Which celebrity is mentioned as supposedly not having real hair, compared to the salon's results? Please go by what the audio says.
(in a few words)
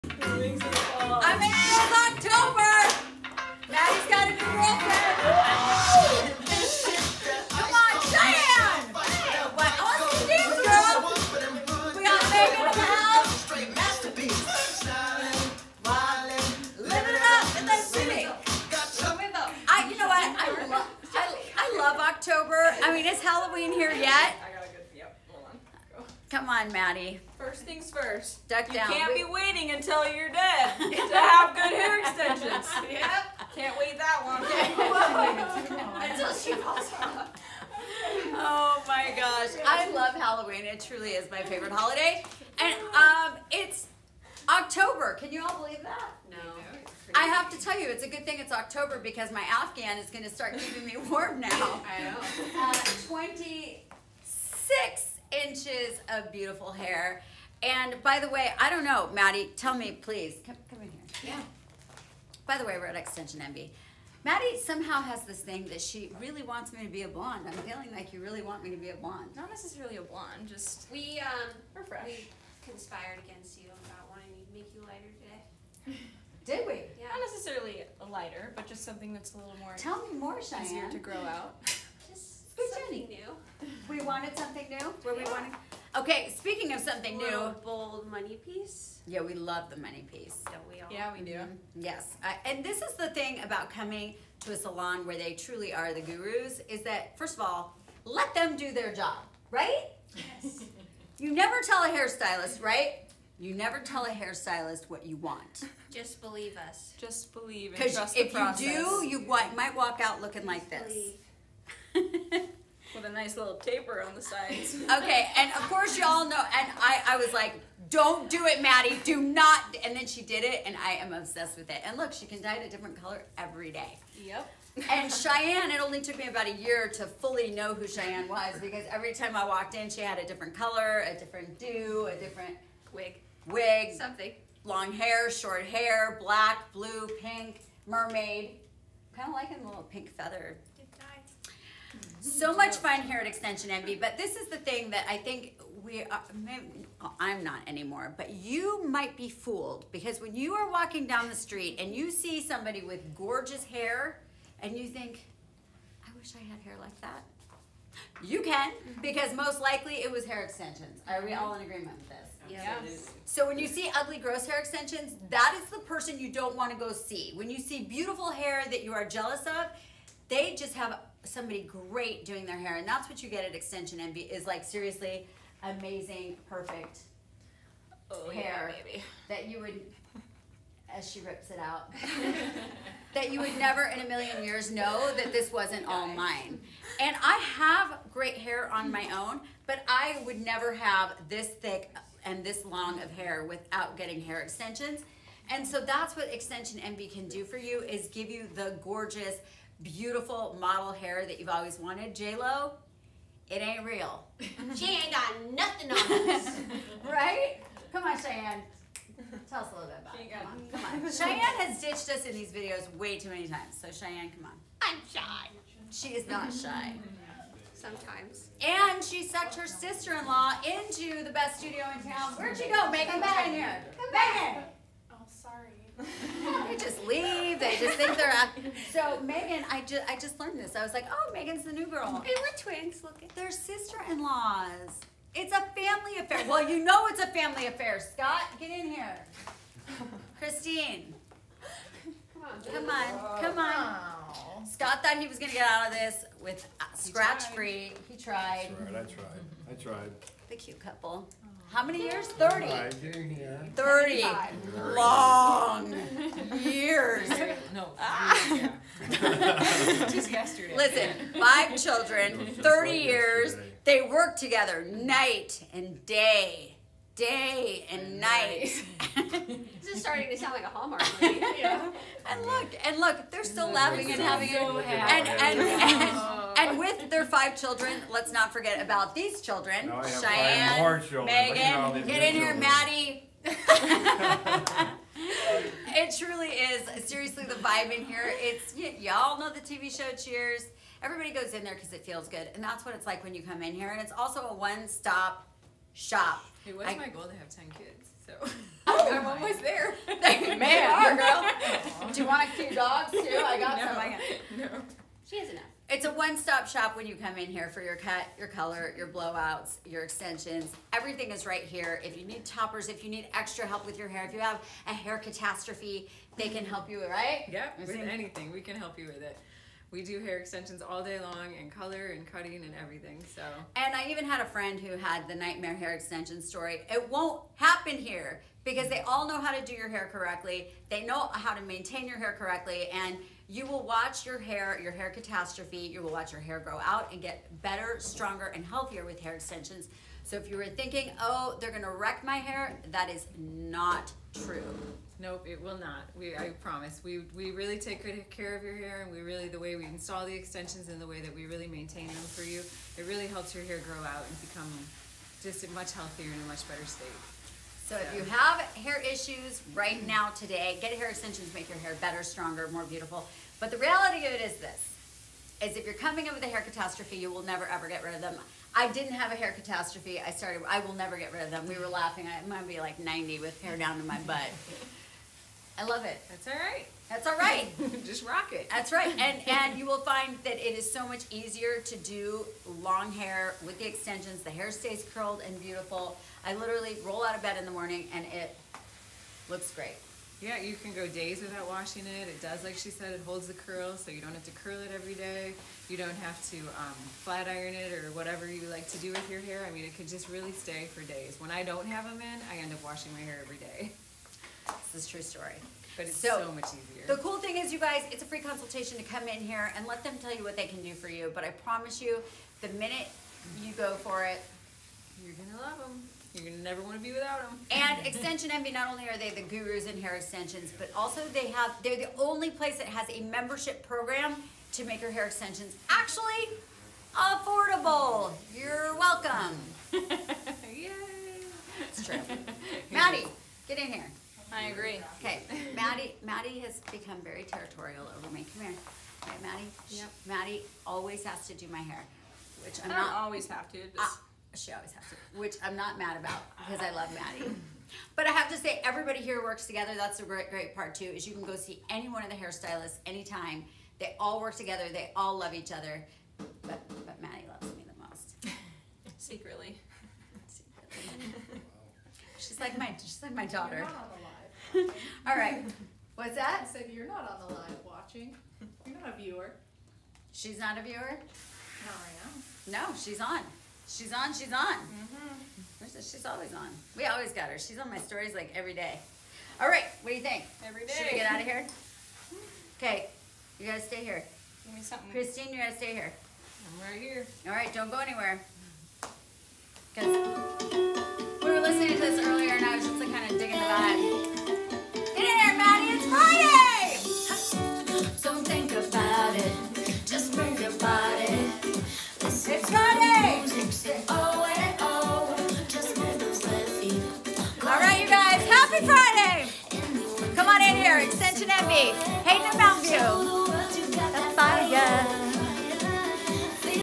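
J-Lo.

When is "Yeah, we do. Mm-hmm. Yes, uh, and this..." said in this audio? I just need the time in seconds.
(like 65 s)
90 s.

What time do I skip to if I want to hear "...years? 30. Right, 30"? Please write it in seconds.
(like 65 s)
252 s.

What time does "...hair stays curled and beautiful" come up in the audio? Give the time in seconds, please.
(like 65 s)
384 s.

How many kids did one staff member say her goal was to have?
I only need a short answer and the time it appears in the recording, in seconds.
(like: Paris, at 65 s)
10, at 297 s.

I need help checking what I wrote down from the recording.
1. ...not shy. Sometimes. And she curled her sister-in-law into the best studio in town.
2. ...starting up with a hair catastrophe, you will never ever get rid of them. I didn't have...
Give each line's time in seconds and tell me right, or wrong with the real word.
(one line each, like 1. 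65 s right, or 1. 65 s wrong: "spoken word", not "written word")
1. 216 s wrong: "sucked", not "curled"
2. 365 s wrong: "coming", not "starting".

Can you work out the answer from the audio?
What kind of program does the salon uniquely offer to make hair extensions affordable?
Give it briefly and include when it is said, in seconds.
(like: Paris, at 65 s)
membership program, at 423 s.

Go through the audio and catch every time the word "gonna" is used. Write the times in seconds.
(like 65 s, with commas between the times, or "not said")
245 s, 341 s.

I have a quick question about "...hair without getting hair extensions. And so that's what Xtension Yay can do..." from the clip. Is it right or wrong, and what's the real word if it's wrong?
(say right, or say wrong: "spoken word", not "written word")
wrong: "Envy", not "Yay".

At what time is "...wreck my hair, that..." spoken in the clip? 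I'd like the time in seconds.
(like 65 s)
341 s.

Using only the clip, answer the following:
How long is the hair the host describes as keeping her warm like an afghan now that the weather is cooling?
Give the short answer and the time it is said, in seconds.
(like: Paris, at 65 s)
26 inches, at 53 s.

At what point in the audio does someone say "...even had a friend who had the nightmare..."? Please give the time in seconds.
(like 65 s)
324 s.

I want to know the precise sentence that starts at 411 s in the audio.
But I promise you, the minute you go for it, you're going to love them.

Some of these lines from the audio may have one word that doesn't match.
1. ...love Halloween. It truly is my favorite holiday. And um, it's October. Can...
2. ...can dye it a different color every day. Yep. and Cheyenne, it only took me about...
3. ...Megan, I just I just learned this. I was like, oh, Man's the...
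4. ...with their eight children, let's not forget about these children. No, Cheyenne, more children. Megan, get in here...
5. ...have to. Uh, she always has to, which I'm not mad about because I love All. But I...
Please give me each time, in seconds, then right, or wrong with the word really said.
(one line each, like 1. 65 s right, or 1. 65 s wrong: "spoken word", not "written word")
1. 39 s right
2. 122 s right
3. 229 s wrong: "Megan", not "Man"
4. 276 s wrong: "five", not "eight"
5. 443 s wrong: "Maddie", not "All".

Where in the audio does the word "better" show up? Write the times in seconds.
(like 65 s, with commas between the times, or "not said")
337 s, 356 s, 361 s.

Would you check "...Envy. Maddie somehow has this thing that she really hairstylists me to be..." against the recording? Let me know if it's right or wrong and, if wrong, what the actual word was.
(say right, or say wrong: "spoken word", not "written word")
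wrong: "wants", not "hairstylists".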